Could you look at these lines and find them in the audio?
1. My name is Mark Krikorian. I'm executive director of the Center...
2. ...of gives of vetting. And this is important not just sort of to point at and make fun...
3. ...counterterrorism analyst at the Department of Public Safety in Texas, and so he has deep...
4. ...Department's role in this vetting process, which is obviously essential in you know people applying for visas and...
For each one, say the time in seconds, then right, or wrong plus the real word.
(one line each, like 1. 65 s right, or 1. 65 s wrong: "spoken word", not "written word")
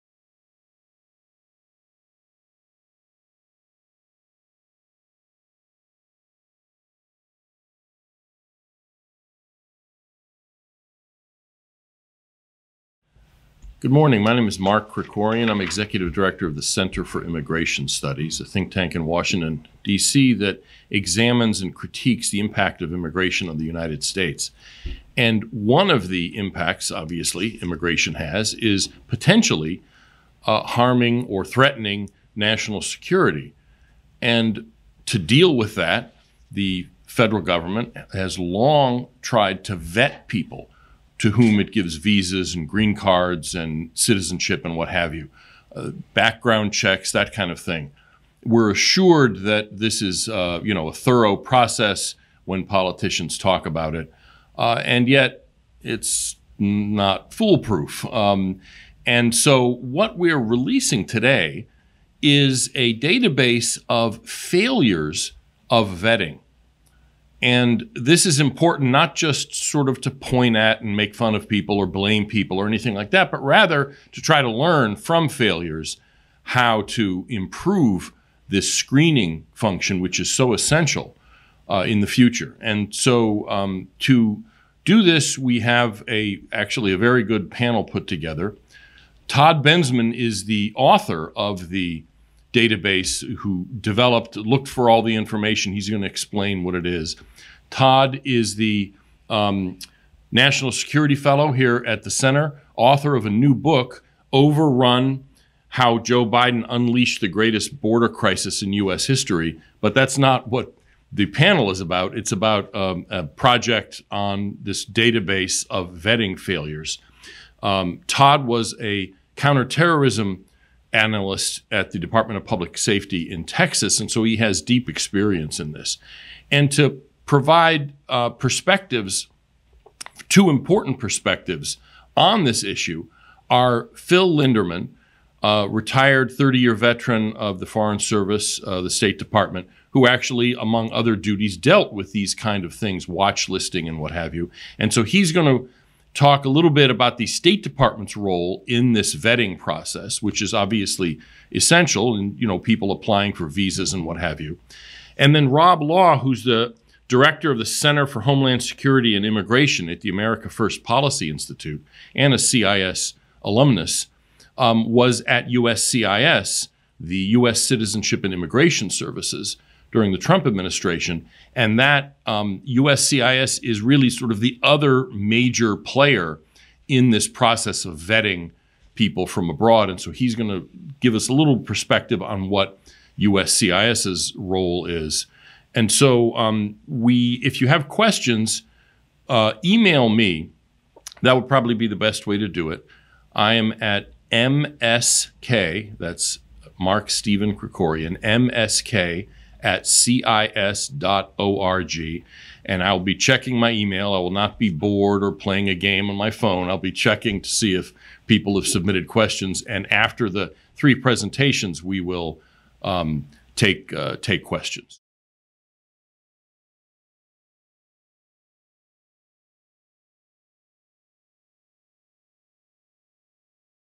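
1. 14 s right
2. 63 s wrong: "failures", not "gives"
3. 119 s right
4. 147 s right.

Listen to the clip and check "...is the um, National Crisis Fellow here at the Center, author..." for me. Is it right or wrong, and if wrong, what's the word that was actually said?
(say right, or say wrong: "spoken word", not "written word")
wrong: "Security", not "Crisis".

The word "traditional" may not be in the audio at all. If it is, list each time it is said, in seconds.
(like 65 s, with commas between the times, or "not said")
not said.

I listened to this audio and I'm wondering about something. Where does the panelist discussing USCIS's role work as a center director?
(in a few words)
America First Policy Institute.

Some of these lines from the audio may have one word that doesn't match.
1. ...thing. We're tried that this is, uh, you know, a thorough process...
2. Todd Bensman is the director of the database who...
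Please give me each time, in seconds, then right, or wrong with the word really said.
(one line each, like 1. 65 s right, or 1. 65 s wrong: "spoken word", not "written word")
1. 47 s wrong: "assured", not "tried"
2. 89 s wrong: "author", not "director".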